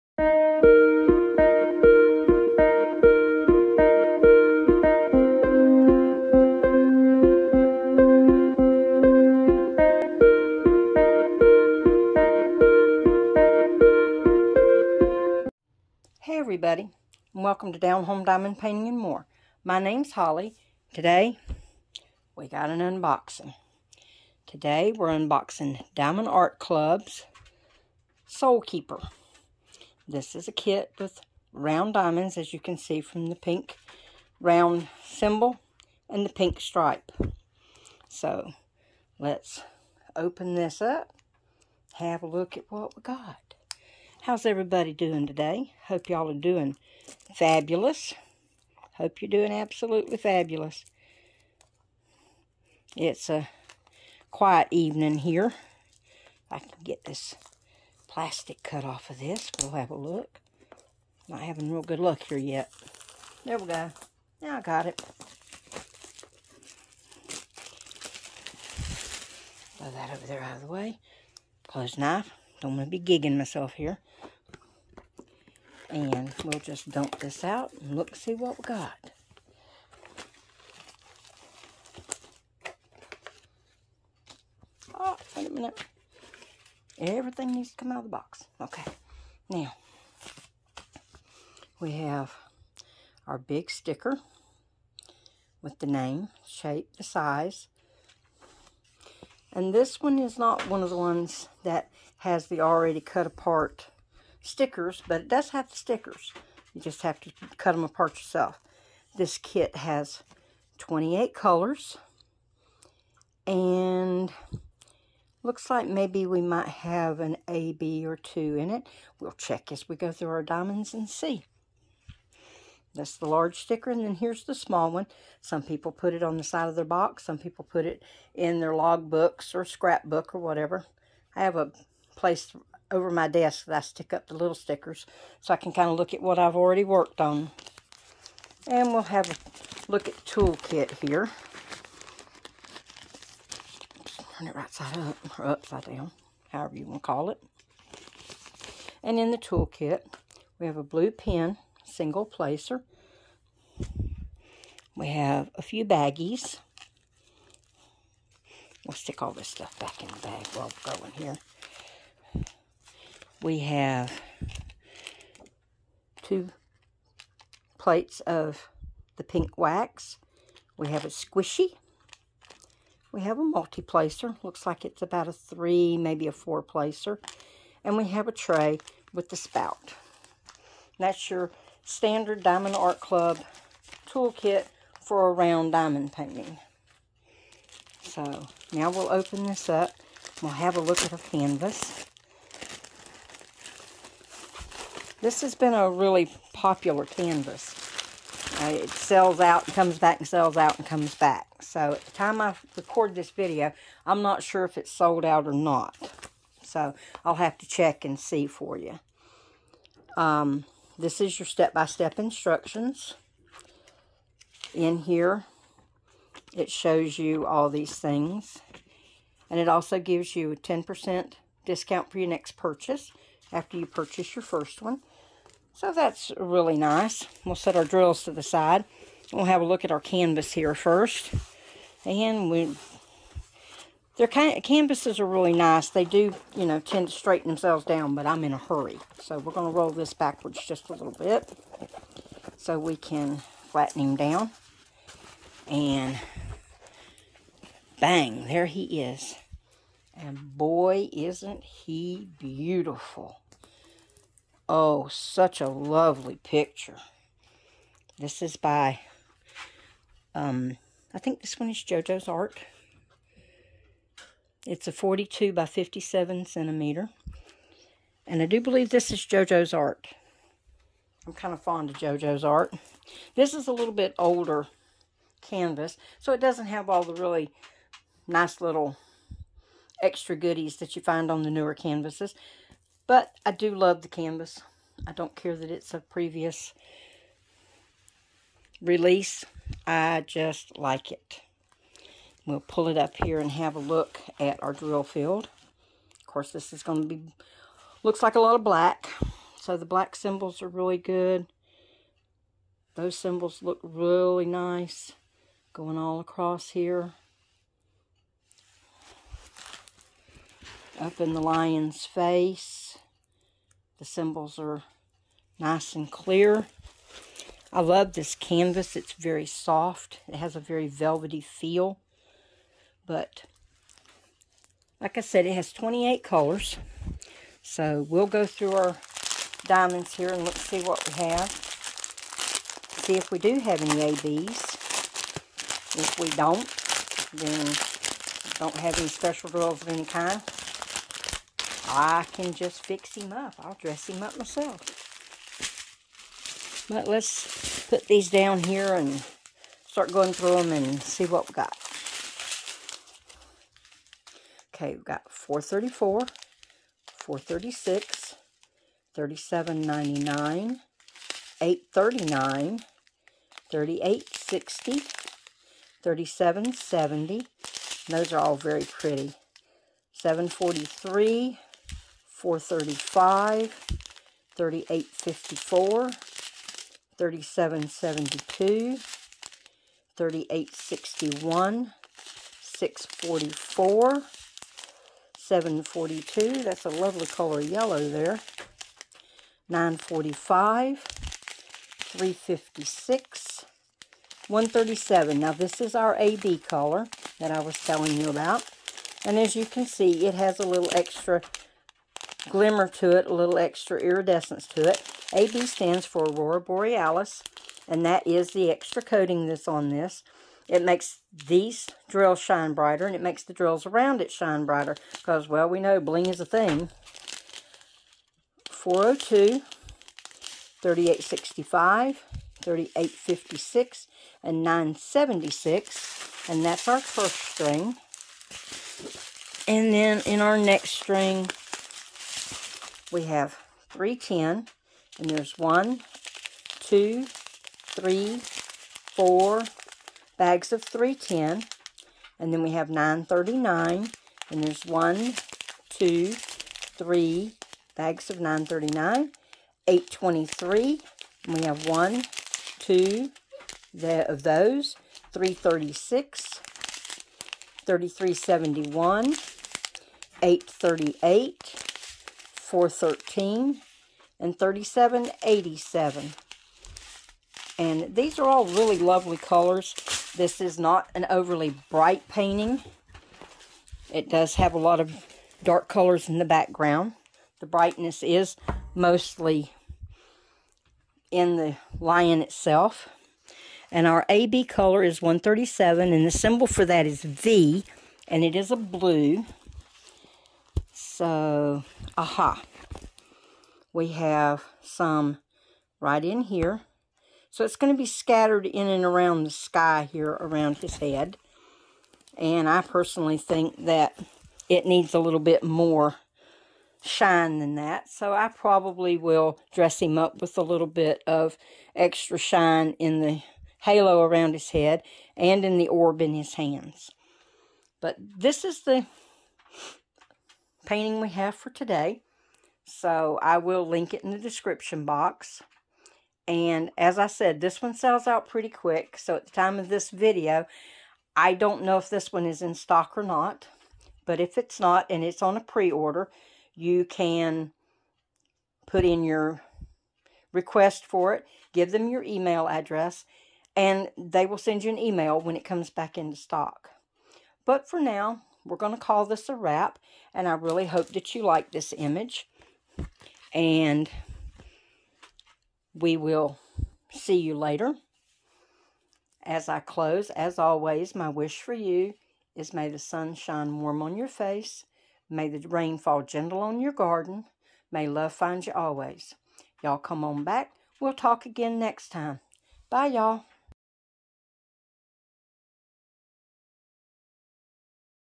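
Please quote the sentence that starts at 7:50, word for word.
This is not an overly bright painting.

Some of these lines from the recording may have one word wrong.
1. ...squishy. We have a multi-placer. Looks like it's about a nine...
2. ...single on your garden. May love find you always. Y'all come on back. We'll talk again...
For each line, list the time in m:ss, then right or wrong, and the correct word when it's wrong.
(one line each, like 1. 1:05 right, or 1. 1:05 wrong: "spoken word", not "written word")
1. 2:51 wrong: "three", not "nine"
2. 9:26 wrong: "gentle", not "single".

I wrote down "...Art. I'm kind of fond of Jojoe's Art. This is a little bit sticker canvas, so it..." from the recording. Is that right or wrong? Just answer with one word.
wrong.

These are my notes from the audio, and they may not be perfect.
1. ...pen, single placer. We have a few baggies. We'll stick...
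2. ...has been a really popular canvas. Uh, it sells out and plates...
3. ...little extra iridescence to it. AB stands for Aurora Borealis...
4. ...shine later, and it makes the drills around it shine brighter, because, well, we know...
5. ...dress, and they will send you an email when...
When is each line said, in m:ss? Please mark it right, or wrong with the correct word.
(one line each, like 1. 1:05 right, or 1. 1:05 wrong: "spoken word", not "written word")
1. 2:31 right
2. 3:15 wrong: "comes", not "plates"
3. 6:43 right
4. 6:52 wrong: "brighter", not "later"
5. 9:02 wrong: "address", not "dress".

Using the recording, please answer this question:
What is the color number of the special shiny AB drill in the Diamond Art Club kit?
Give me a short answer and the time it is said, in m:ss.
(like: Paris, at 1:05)
137, at 8:05.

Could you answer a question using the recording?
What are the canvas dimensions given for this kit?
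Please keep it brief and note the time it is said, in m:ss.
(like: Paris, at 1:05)
42 by 57 centimeters, at 4:24.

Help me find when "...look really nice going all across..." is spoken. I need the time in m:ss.
5:03.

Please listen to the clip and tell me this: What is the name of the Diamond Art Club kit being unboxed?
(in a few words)
Soul Keeper.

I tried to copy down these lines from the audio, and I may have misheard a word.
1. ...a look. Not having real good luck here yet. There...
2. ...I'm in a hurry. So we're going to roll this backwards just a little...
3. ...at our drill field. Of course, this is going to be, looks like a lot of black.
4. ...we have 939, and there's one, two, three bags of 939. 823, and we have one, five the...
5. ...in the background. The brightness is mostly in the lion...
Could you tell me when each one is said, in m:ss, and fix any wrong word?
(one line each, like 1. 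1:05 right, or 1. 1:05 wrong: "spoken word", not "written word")
1. 0:59 right
2. 3:58 right
3. 4:54 right
4. 7:22 wrong: "two", not "five"
5. 7:56 right.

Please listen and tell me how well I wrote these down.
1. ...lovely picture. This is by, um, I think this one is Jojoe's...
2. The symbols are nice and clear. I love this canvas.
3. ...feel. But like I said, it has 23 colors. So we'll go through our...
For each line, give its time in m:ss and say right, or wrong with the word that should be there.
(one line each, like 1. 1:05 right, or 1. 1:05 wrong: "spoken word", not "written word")
1. 4:15 right
2. 5:14 right
3. 5:21 wrong: "28", not "23".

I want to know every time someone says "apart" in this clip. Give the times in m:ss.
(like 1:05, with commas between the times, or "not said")
1:43, 1:47.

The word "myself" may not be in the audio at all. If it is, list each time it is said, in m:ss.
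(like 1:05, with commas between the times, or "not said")
1:13, 5:44.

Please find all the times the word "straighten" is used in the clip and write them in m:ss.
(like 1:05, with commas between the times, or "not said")
3:57.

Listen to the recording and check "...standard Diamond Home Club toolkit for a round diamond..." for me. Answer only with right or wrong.
wrong.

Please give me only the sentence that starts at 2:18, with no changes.
And we'll have a look at toolkit here.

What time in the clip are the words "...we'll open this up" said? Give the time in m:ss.
3:08.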